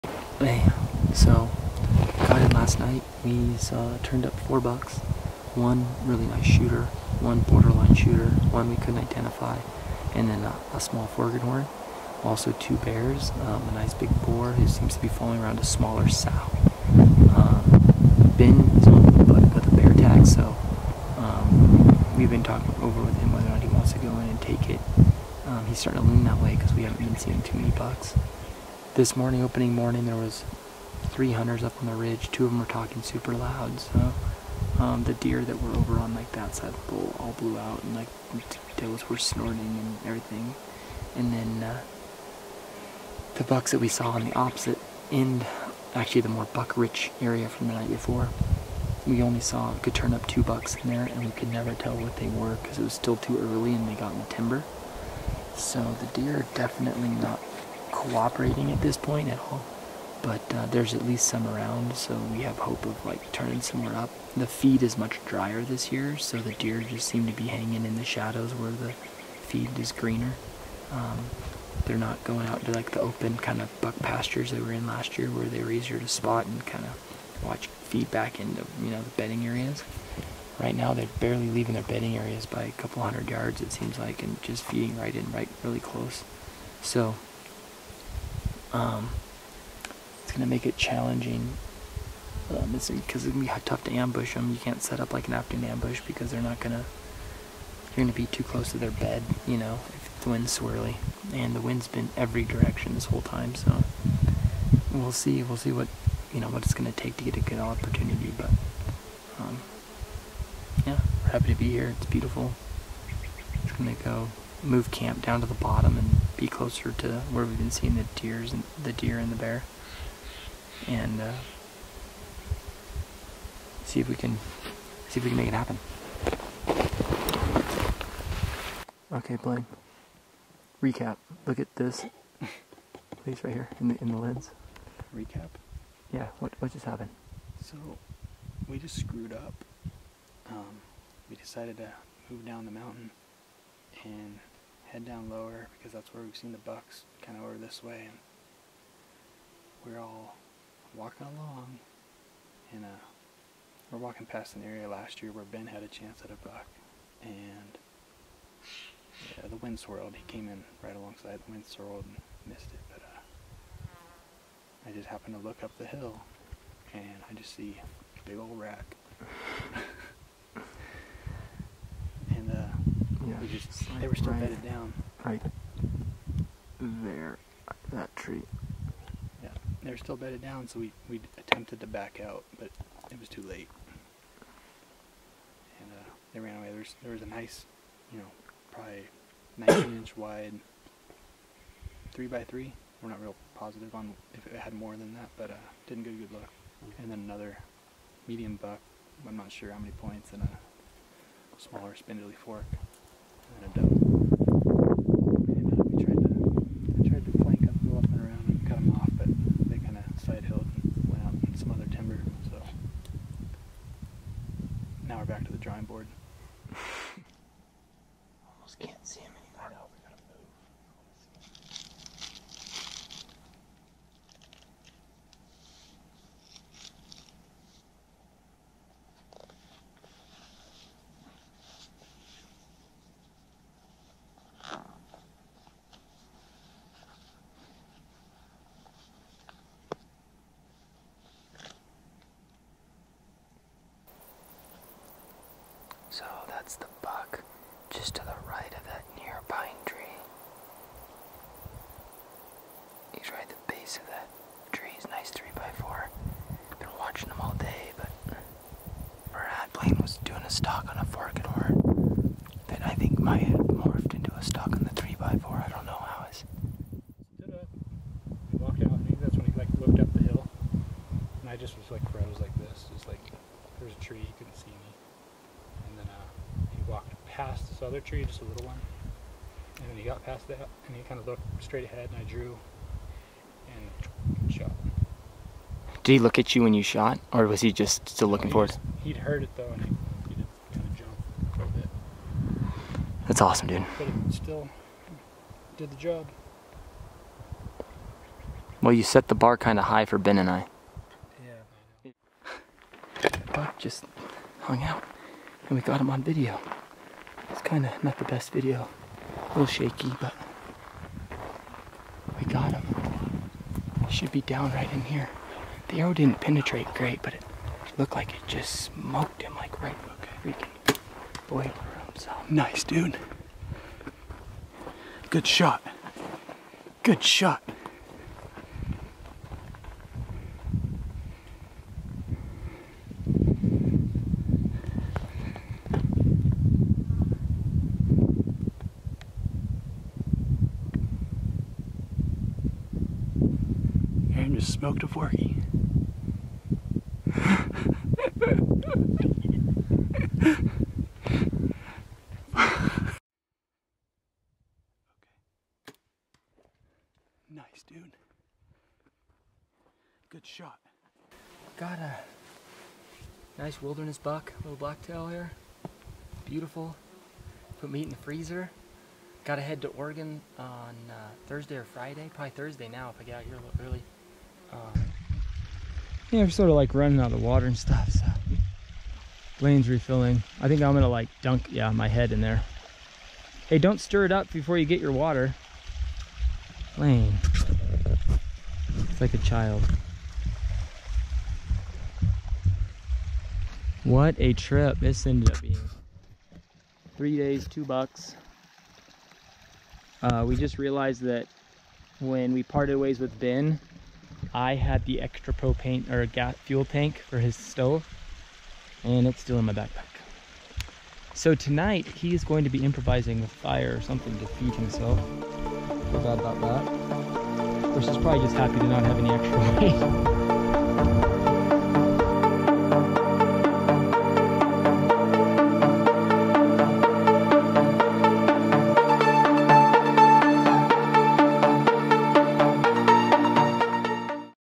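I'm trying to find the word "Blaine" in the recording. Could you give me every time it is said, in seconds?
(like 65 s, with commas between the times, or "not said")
129 s, 259 s.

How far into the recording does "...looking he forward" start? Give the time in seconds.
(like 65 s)
288 s.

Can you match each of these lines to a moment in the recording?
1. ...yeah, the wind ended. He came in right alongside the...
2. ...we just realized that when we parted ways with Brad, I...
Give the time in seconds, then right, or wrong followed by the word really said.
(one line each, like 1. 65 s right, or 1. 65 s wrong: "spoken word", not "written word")
1. 159 s wrong: "swirled", not "ended"
2. 400 s wrong: "Ben", not "Brad".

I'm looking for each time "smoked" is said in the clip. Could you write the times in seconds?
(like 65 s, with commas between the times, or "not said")
318 s, 344 s.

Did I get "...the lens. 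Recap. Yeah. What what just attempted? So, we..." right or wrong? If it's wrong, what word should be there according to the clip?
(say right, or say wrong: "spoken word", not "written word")
wrong: "happened", not "attempted".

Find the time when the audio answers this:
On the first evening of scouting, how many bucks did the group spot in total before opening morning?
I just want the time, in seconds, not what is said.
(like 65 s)
4 s.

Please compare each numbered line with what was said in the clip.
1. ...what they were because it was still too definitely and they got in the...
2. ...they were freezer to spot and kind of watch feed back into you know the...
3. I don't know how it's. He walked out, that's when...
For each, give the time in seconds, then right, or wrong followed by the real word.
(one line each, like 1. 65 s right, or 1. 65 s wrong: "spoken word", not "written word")
1. 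51 s wrong: "early", not "definitely"
2. 75 s wrong: "easier", not "freezer"
3. 265 s right.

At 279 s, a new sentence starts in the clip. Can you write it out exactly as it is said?
And then he got past that and he kind of looked straight ahead and I drew and shot.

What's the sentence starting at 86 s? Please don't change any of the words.
So um, it's going to make it challenging because um, it's, it's going to be tough to ambush them.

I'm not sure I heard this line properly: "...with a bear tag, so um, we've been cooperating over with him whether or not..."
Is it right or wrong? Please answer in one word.
wrong.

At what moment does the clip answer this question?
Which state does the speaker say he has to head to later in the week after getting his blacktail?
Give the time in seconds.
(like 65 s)
369 s.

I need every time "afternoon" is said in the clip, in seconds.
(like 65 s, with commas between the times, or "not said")
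95 s.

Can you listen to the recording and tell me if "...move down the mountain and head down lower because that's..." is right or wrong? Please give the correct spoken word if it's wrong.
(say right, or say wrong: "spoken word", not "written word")
right.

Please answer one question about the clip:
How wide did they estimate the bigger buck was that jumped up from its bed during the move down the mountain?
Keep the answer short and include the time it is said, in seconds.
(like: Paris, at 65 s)
19 inches, at 189 s.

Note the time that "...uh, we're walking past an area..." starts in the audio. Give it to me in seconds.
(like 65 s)
152 s.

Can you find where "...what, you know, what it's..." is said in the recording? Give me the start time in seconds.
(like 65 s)
105 s.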